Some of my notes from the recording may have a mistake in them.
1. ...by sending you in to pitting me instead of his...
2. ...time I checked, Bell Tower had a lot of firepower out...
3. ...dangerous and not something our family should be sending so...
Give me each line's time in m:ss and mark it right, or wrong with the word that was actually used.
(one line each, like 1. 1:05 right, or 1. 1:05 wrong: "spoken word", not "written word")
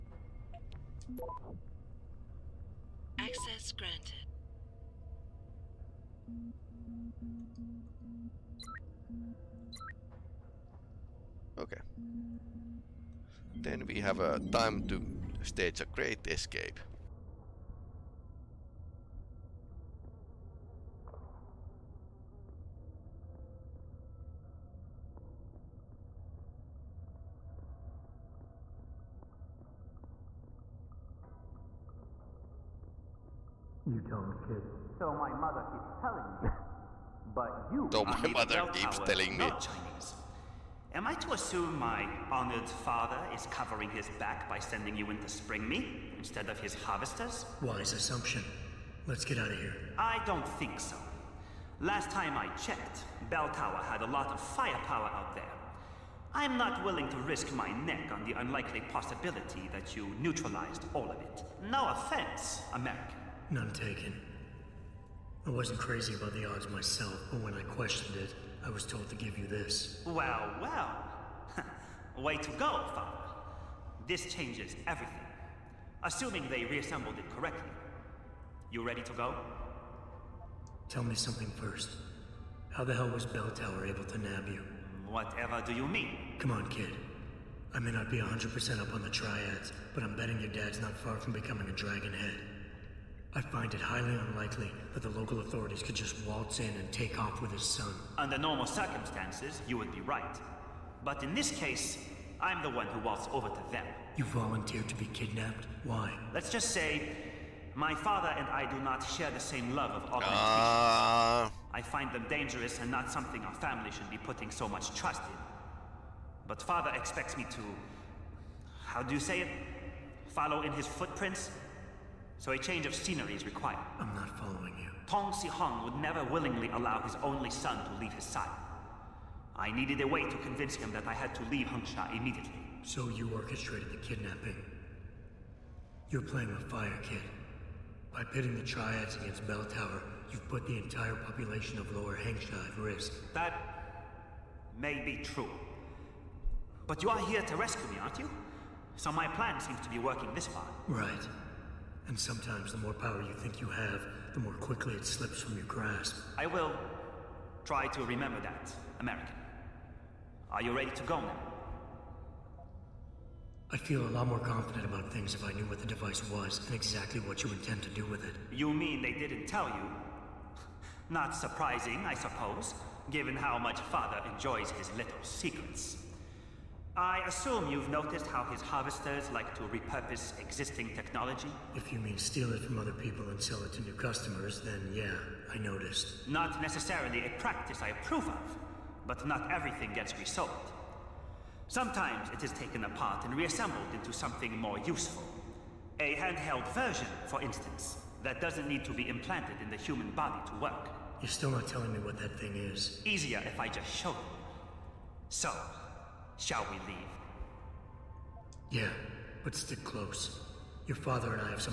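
1. 0:44 wrong: "spring", not "pitting"
2. 0:52 right
3. 1:52 wrong: "putting", not "sending".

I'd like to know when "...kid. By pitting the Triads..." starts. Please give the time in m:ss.
2:17.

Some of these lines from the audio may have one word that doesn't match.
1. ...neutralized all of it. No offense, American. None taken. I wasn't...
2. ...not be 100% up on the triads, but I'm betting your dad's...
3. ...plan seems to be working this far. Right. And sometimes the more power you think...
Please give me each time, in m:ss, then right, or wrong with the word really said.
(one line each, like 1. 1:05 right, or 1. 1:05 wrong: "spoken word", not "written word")
1. 1:00 right
2. 1:27 right
3. 2:29 right.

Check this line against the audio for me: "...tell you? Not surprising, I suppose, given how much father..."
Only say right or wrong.
right.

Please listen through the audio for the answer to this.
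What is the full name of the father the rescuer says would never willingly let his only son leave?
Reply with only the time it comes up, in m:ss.
2:05.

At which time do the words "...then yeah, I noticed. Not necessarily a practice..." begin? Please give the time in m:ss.
3:04.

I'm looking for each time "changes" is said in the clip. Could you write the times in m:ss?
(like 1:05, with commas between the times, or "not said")
1:14, 2:02.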